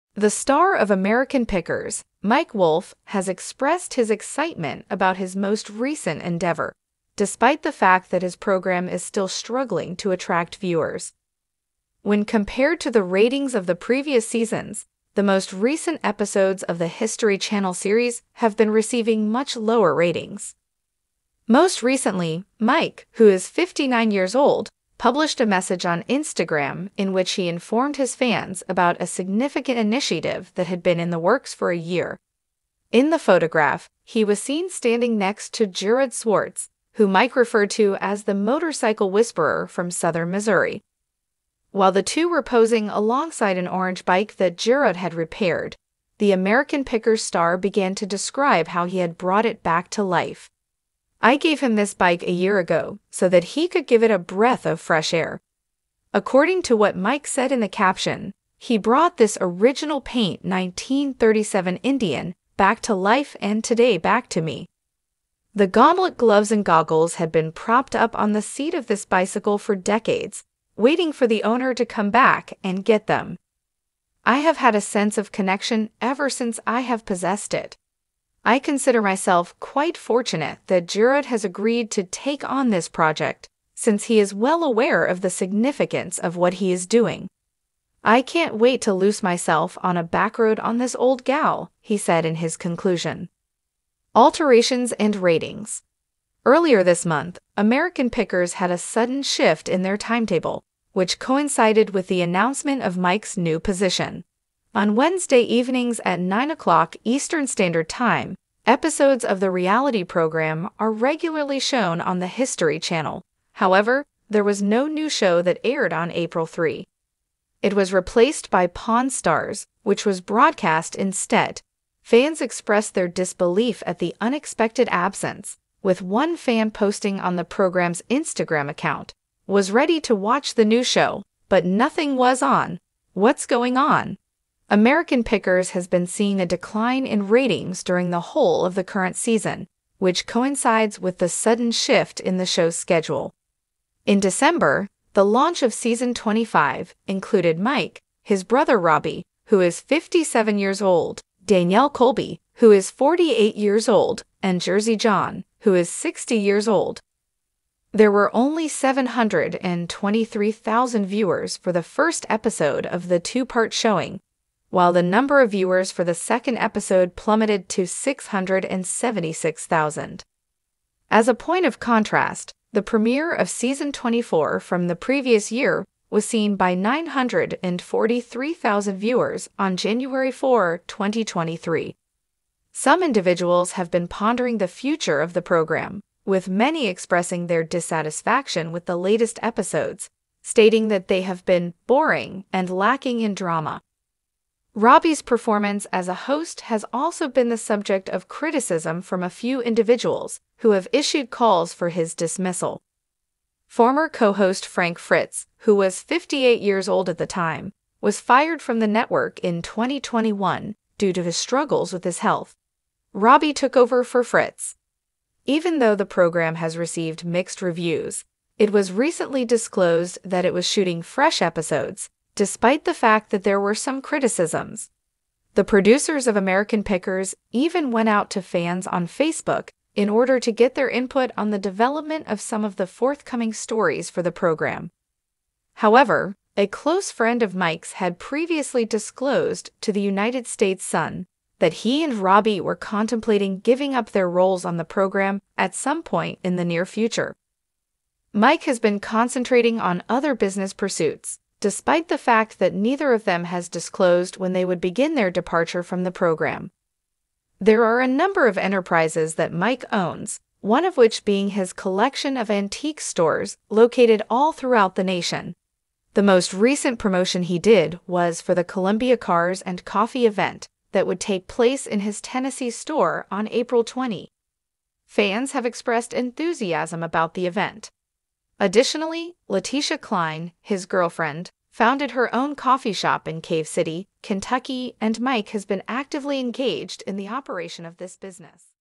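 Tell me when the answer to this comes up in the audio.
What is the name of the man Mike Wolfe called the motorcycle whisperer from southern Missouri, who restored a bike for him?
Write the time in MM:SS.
00:35.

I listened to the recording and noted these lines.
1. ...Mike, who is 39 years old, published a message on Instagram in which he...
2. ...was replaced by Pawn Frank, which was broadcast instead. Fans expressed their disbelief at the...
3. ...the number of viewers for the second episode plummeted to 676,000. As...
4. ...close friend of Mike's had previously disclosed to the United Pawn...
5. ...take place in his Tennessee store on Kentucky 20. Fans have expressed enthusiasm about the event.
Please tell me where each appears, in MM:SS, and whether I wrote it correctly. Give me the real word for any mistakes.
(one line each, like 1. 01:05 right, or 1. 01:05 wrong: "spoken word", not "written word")
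1. 00:22 wrong: "59", not "39"
2. 01:57 wrong: "Stars", not "Frank"
3. 02:44 right
4. 03:56 wrong: "States", not "Pawn"
5. 04:31 wrong: "April", not "Kentucky".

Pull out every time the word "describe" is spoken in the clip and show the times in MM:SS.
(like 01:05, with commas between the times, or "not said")
00:48.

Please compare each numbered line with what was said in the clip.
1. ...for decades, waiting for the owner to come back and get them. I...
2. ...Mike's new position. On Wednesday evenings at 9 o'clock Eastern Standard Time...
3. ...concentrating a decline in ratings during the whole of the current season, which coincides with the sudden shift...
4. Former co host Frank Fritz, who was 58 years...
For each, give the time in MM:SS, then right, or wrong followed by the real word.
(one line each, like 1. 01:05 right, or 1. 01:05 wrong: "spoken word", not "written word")
1. 01:09 right
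2. 01:42 right
3. 02:16 wrong: "seeing", not "concentrating"
4. 03:23 right.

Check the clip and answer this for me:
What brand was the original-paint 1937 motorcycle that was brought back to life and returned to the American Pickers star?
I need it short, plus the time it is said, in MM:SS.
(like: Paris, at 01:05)
Indian, at 01:01.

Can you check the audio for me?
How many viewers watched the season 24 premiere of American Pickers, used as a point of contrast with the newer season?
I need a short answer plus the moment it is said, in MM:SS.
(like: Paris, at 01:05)
943,000, at 02:56.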